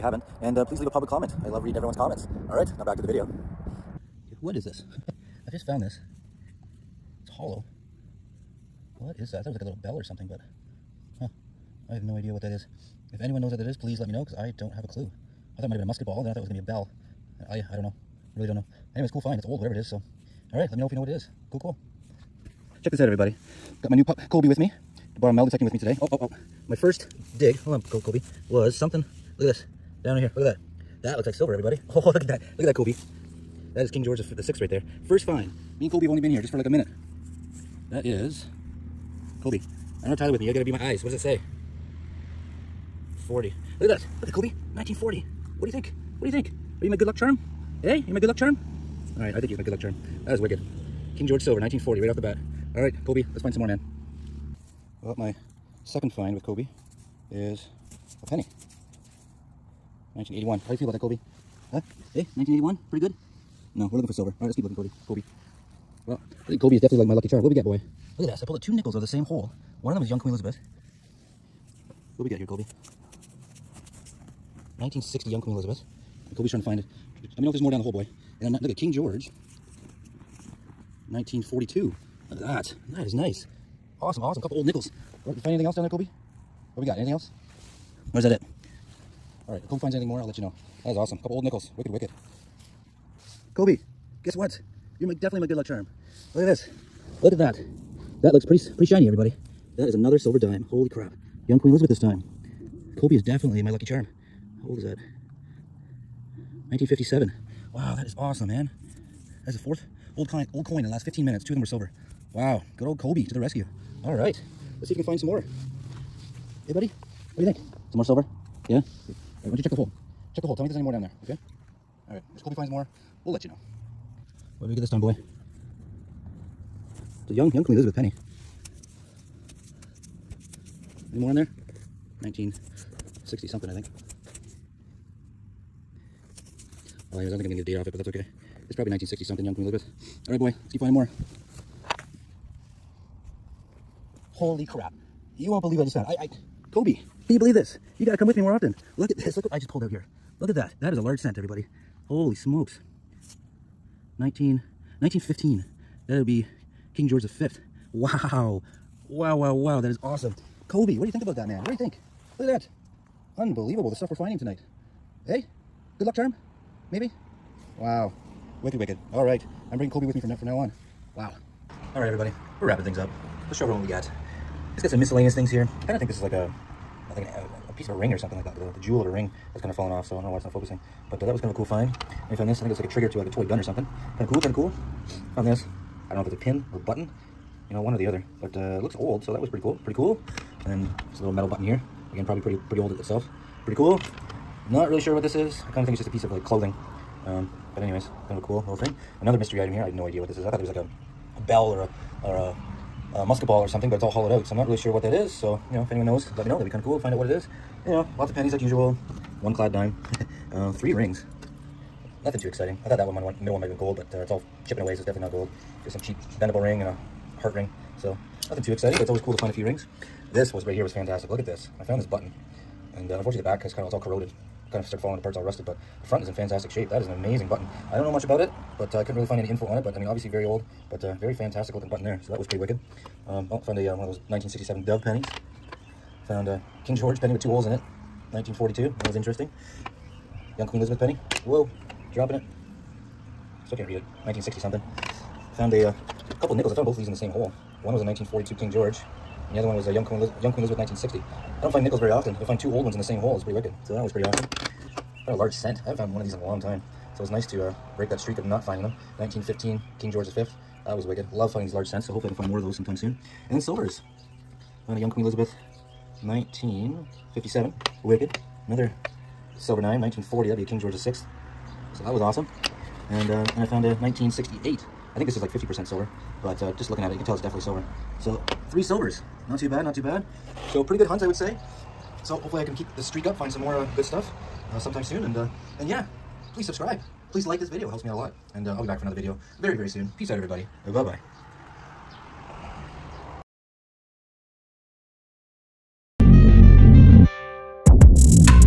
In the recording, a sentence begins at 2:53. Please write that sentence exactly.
Let's show everyone what we got.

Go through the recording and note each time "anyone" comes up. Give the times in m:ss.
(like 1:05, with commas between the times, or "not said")
0:13, 3:25.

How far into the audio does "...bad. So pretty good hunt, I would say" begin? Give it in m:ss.
4:40.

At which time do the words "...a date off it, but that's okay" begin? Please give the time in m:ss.
2:17.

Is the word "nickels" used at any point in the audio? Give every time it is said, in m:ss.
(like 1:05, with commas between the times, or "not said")
1:08, 1:24, 1:31, 4:06, 4:11.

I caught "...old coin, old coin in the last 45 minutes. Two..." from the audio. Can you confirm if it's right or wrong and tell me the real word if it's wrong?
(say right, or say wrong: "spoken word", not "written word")
wrong: "15", not "45".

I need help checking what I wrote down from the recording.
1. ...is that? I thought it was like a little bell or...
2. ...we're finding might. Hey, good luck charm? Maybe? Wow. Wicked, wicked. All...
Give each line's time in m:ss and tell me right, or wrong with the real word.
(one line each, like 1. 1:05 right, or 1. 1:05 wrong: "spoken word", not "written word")
1. 0:09 right
2. 2:44 wrong: "tonight", not "might".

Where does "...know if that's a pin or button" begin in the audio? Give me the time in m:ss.
3:06.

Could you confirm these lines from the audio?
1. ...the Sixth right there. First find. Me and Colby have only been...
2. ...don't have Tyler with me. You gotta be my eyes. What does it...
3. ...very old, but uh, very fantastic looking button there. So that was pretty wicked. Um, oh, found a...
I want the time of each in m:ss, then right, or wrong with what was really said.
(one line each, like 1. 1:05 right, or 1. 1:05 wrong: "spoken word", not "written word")
1. 0:34 right
2. 0:40 right
3. 3:50 right.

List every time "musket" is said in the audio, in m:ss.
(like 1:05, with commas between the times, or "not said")
0:15, 3:23.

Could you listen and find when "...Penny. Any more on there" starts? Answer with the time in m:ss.
2:07.